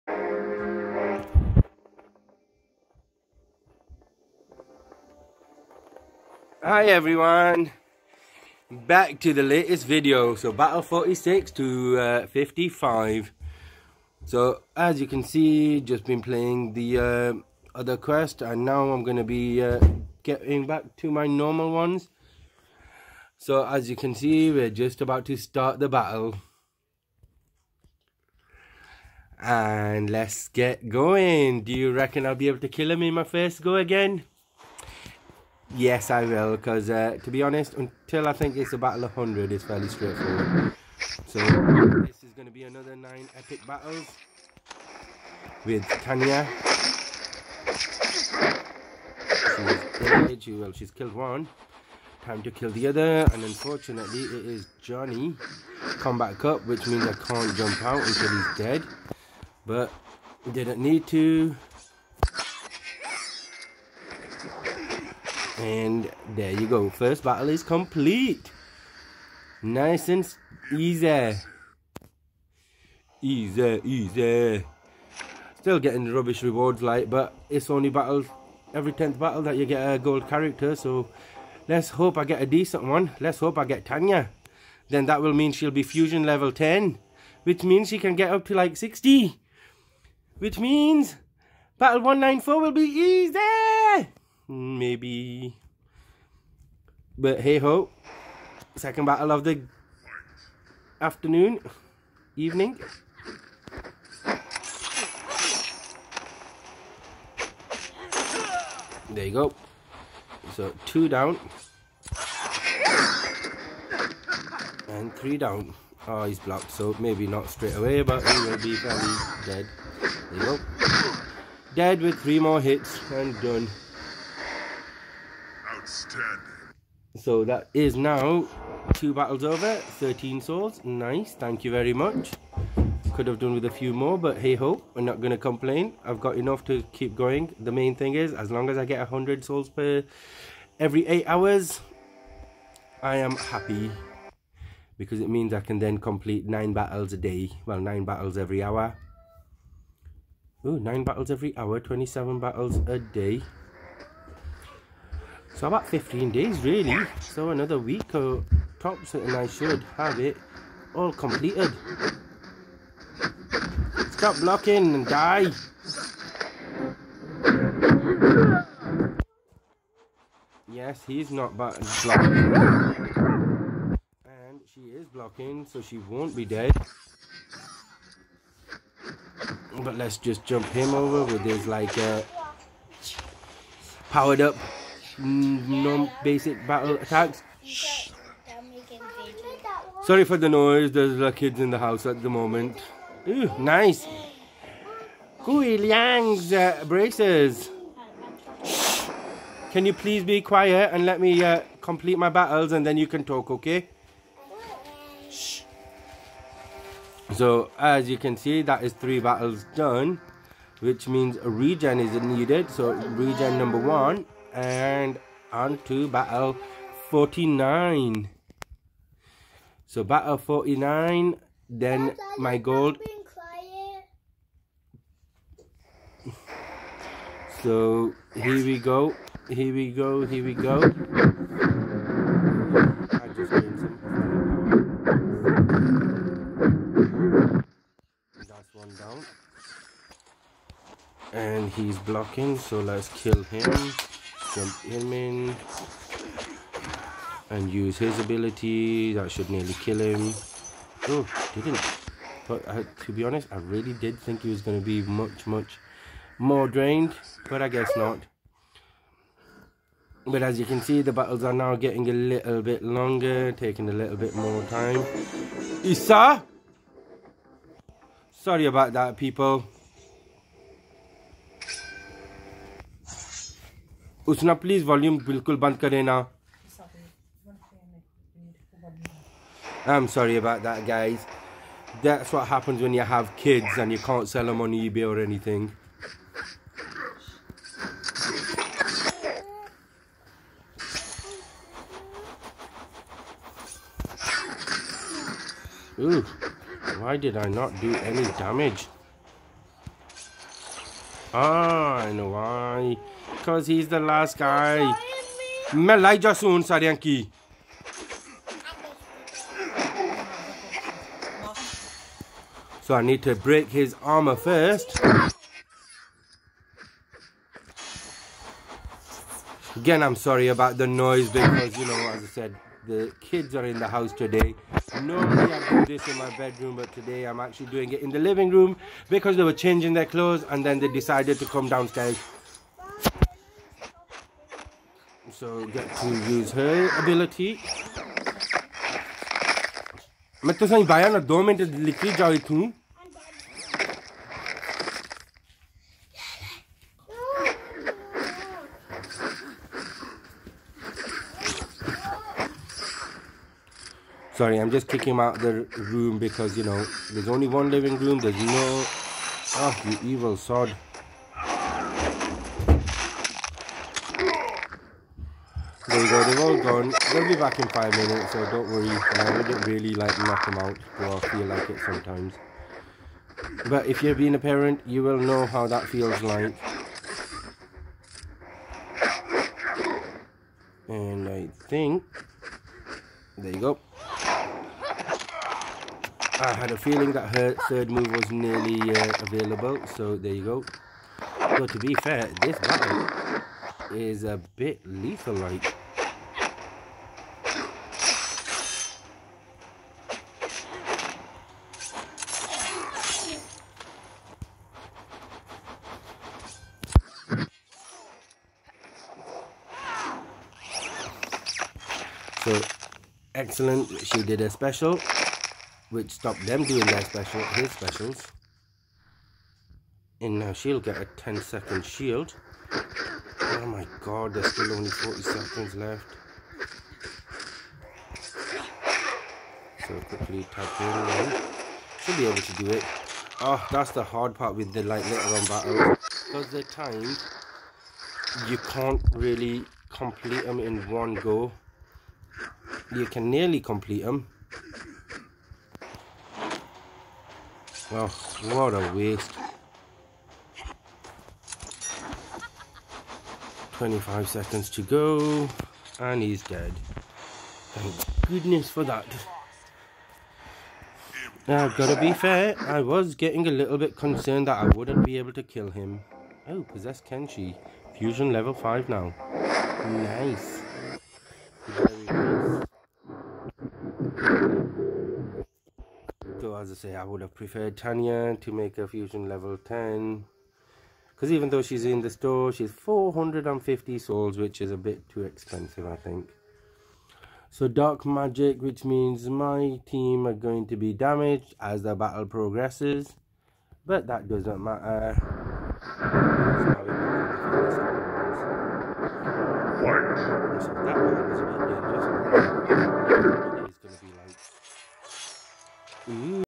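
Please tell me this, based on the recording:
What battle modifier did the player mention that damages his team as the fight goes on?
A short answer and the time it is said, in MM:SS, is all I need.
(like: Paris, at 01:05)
Dark Magic, at 08:07.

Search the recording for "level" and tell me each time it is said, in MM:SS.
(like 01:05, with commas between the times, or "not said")
01:26, 07:48, 07:59.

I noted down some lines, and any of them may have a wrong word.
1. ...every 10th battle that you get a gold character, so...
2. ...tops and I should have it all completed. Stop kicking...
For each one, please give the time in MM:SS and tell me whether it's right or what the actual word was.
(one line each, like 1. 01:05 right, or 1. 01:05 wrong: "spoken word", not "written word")
1. 01:18 right
2. 02:38 wrong: "blocking", not "kicking".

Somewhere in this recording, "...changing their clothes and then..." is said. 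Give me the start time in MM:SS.
05:29.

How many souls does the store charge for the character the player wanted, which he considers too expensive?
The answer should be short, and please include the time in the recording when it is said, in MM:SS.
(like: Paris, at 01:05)
450, at 08:02.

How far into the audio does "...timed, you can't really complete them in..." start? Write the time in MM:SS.
07:16.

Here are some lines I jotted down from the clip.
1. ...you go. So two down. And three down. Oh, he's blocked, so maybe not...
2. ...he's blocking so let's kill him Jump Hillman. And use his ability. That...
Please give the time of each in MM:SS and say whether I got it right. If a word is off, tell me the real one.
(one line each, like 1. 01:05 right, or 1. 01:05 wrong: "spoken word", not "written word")
1. 01:49 right
2. 04:01 right.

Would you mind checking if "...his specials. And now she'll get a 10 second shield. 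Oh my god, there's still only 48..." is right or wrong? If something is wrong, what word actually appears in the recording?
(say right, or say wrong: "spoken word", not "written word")
wrong: "40", not "48".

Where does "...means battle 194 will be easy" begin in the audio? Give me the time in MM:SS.
01:30.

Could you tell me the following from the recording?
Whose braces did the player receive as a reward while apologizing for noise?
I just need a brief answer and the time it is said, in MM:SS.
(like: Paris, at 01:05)
Kuai Liang, at 03:15.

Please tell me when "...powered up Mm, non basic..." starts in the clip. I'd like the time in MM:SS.
03:04.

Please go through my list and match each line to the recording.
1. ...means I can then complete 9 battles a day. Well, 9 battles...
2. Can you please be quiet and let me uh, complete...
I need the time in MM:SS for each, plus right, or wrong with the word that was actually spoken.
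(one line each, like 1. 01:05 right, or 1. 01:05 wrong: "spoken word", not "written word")
1. 02:25 right
2. 03:19 right.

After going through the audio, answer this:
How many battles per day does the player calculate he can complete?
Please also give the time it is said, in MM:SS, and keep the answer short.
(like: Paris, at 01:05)
27, at 02:31.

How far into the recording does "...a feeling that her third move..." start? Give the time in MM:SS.
06:26.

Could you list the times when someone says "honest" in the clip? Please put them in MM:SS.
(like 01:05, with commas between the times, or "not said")
00:37, 04:13.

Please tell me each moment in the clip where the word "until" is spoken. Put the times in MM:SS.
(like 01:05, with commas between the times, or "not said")
00:37, 00:58.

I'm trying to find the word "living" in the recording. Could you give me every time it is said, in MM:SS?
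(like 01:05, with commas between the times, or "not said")
05:28, 05:57.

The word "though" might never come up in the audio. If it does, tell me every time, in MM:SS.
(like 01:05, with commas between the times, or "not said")
06:10, 08:01.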